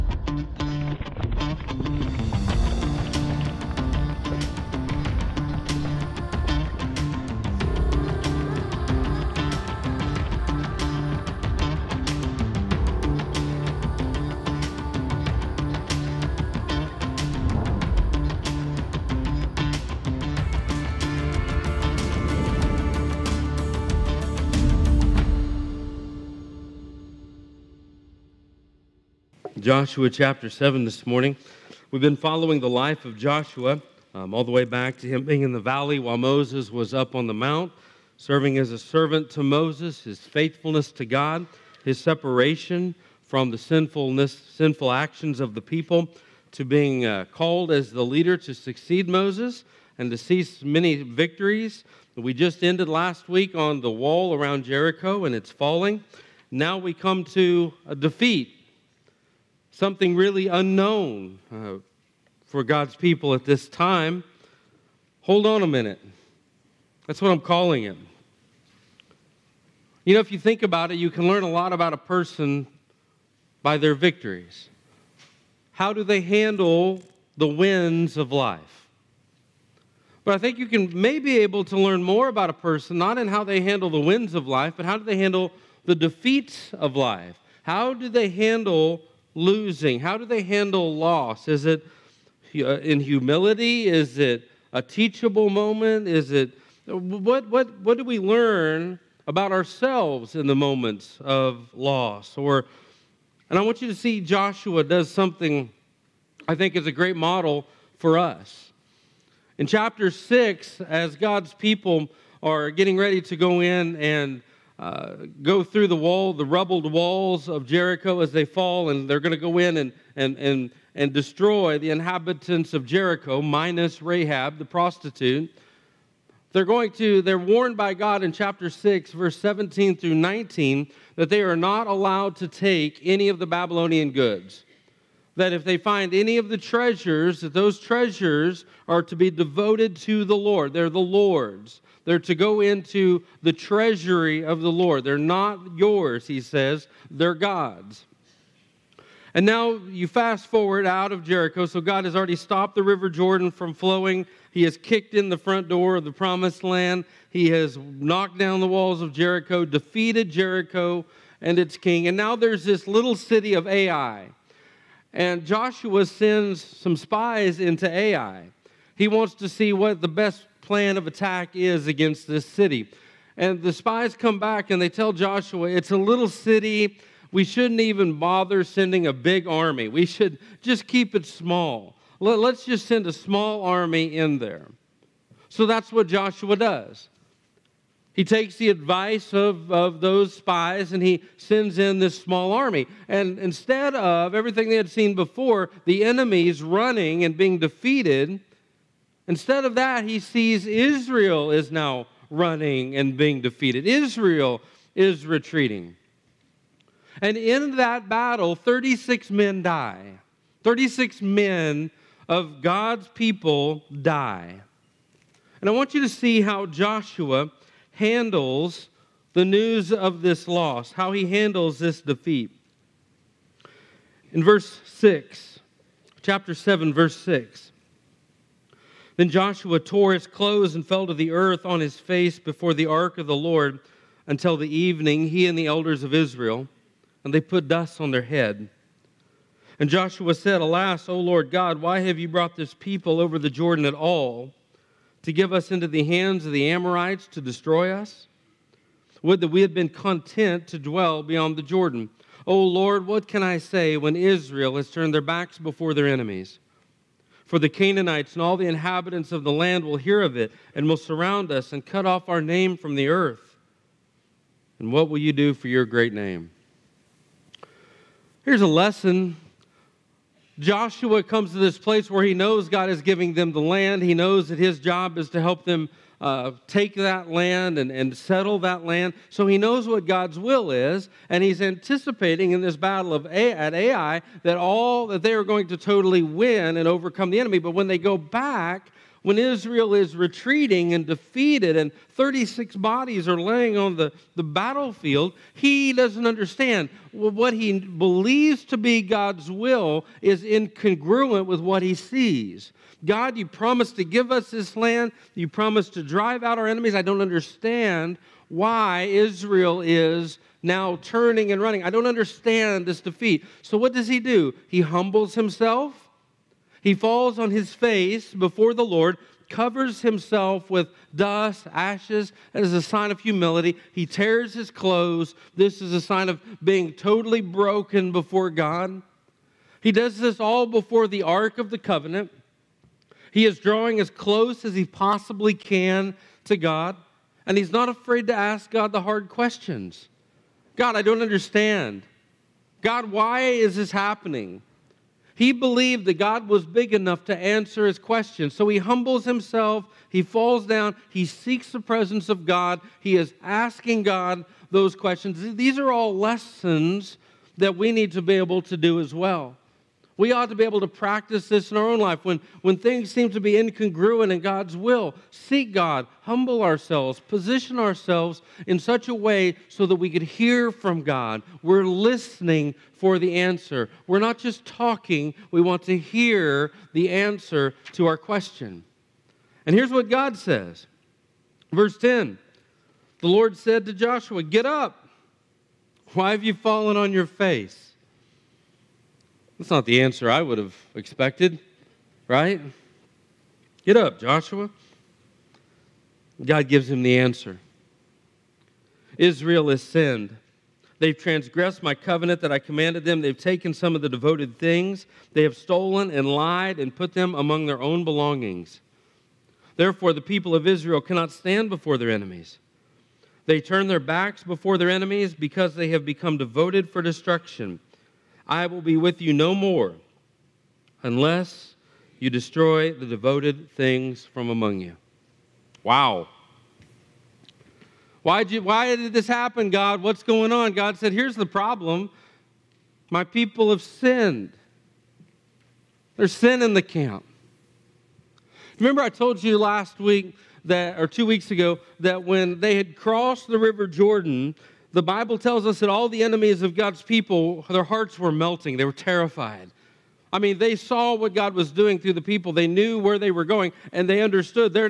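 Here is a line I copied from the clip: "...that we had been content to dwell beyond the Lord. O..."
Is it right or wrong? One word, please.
wrong.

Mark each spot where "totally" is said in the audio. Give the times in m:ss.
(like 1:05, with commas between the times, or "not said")
4:45, 5:26.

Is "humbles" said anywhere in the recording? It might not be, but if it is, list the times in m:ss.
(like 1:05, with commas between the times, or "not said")
5:14, 5:48, 6:06.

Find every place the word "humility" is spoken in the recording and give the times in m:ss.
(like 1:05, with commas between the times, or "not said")
1:32, 5:23.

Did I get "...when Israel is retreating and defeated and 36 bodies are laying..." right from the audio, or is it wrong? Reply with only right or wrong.
right.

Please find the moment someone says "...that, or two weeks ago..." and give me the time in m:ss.
7:20.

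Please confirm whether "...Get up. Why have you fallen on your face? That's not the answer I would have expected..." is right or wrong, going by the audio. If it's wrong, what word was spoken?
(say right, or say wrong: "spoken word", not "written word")
right.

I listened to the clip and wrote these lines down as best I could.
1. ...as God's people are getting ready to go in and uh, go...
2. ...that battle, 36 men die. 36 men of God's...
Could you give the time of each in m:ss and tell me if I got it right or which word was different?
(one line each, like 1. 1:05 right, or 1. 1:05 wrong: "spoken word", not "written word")
1. 1:50 right
2. 3:27 right.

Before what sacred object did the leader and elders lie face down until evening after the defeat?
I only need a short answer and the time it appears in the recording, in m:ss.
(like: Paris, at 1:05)
the ark of the Lord, at 3:52.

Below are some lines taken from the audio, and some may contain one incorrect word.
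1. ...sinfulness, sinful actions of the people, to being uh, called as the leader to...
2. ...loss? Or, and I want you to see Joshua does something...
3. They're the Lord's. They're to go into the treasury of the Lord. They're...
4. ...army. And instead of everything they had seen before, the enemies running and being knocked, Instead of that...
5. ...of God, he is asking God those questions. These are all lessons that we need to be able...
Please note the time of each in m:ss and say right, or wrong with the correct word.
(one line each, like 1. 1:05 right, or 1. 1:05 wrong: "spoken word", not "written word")
1. 0:43 right
2. 1:41 right
3. 2:20 right
4. 3:12 wrong: "defeated", not "knocked"
5. 5:52 right.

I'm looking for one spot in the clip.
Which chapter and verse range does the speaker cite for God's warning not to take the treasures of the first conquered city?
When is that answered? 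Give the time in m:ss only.
2:08.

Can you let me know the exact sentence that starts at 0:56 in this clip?
Now we come to a defeat something really unknown uh, for God's people at this time.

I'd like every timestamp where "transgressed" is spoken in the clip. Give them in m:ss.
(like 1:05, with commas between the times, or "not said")
6:41.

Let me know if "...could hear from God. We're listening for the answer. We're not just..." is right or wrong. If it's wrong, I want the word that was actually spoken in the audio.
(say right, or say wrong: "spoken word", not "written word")
right.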